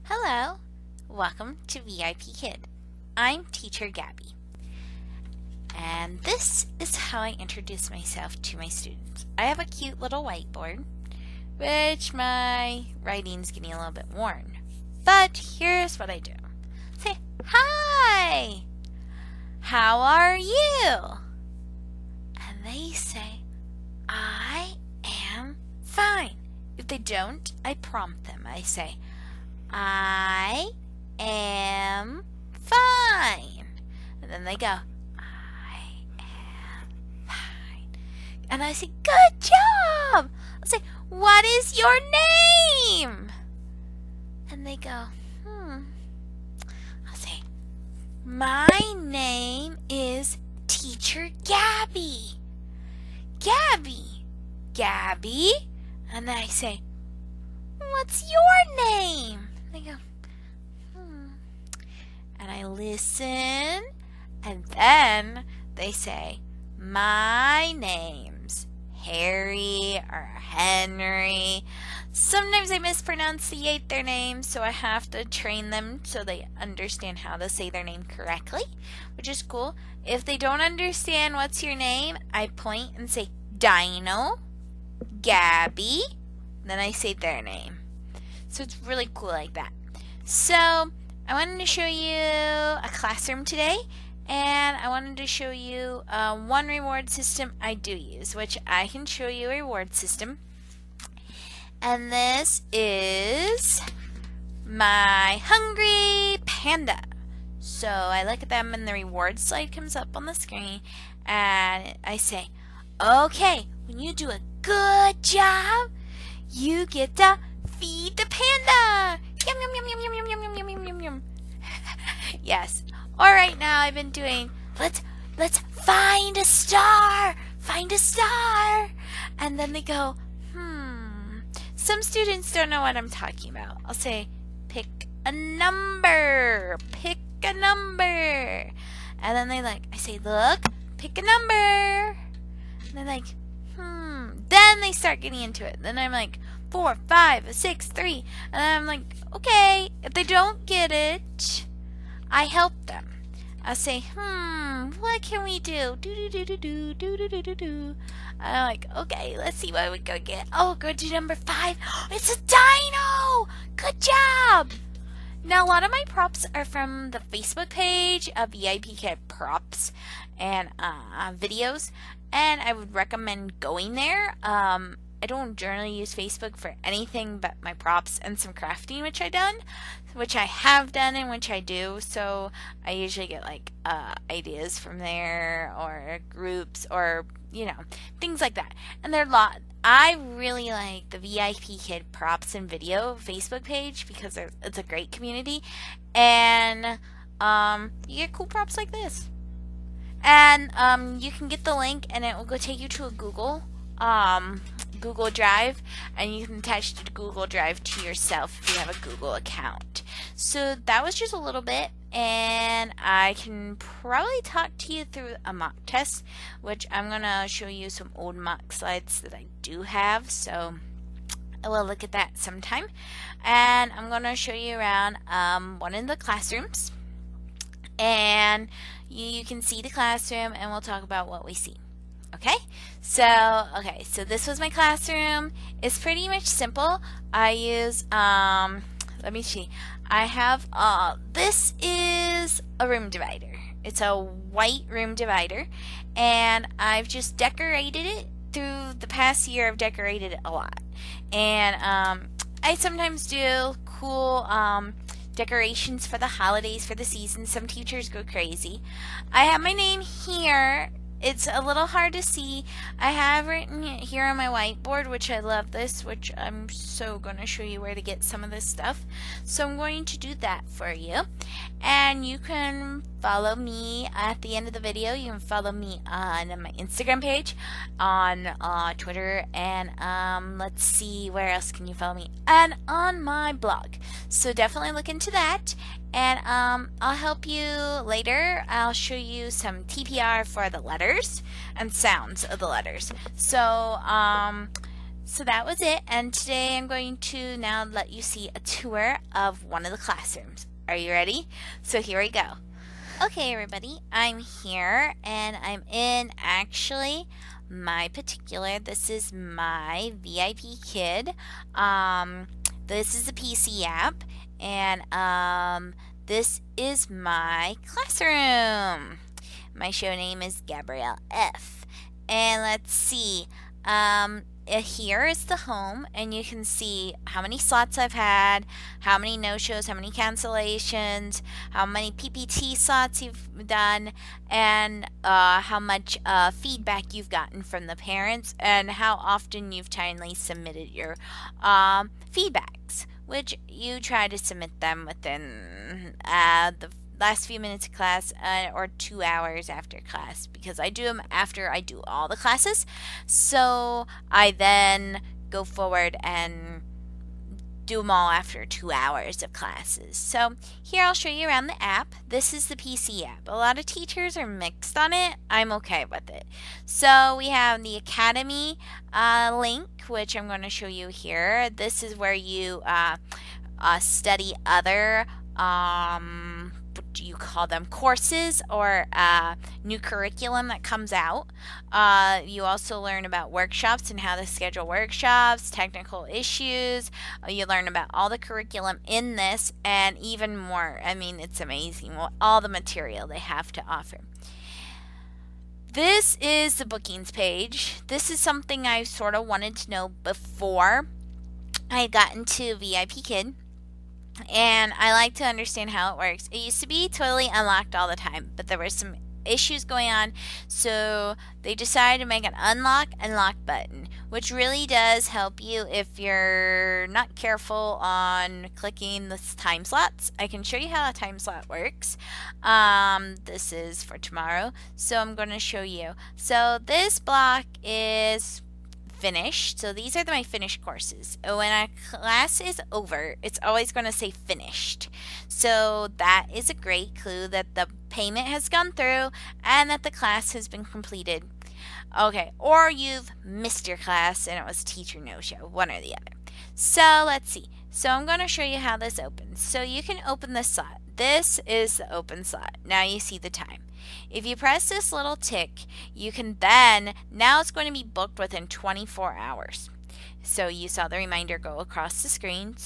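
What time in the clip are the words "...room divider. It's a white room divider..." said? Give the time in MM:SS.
04:02.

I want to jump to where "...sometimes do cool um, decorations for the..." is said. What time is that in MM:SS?
04:12.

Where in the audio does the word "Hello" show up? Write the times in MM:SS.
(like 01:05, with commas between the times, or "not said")
00:00.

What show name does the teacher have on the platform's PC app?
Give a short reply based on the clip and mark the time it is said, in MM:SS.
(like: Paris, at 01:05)
Gabrielle F., at 05:20.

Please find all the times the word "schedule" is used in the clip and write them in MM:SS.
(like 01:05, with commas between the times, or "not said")
06:24.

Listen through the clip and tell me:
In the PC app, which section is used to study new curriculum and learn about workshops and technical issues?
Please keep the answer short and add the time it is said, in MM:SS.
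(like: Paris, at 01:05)
Academy, at 06:07.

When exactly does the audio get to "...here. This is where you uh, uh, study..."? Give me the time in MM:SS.
06:11.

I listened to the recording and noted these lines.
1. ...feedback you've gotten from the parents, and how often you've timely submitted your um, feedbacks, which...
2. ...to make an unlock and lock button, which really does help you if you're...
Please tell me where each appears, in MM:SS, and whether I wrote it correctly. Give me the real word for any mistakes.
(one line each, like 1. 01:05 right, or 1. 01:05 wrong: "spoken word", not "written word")
1. 05:36 right
2. 06:52 right.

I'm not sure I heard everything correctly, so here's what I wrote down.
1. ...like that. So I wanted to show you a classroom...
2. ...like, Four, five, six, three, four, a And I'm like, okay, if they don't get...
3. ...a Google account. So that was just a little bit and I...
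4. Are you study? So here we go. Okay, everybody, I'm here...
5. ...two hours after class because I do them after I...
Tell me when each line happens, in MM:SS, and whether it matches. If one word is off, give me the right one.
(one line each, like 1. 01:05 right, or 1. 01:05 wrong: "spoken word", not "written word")
1. 01:29 right
2. 02:26 wrong: "five", not "four"
3. 03:28 right
4. 05:00 wrong: "ready", not "study"
5. 05:48 right.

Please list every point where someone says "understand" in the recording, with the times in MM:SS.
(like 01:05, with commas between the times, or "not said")
01:16, 01:20, 06:45.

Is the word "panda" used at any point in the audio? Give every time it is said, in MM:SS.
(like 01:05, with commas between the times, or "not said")
01:46, 01:58.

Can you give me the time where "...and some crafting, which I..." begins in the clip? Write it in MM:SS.
02:58.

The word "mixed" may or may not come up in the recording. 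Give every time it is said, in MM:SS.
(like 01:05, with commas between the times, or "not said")
06:04.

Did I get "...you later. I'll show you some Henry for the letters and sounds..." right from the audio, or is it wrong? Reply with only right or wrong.
wrong.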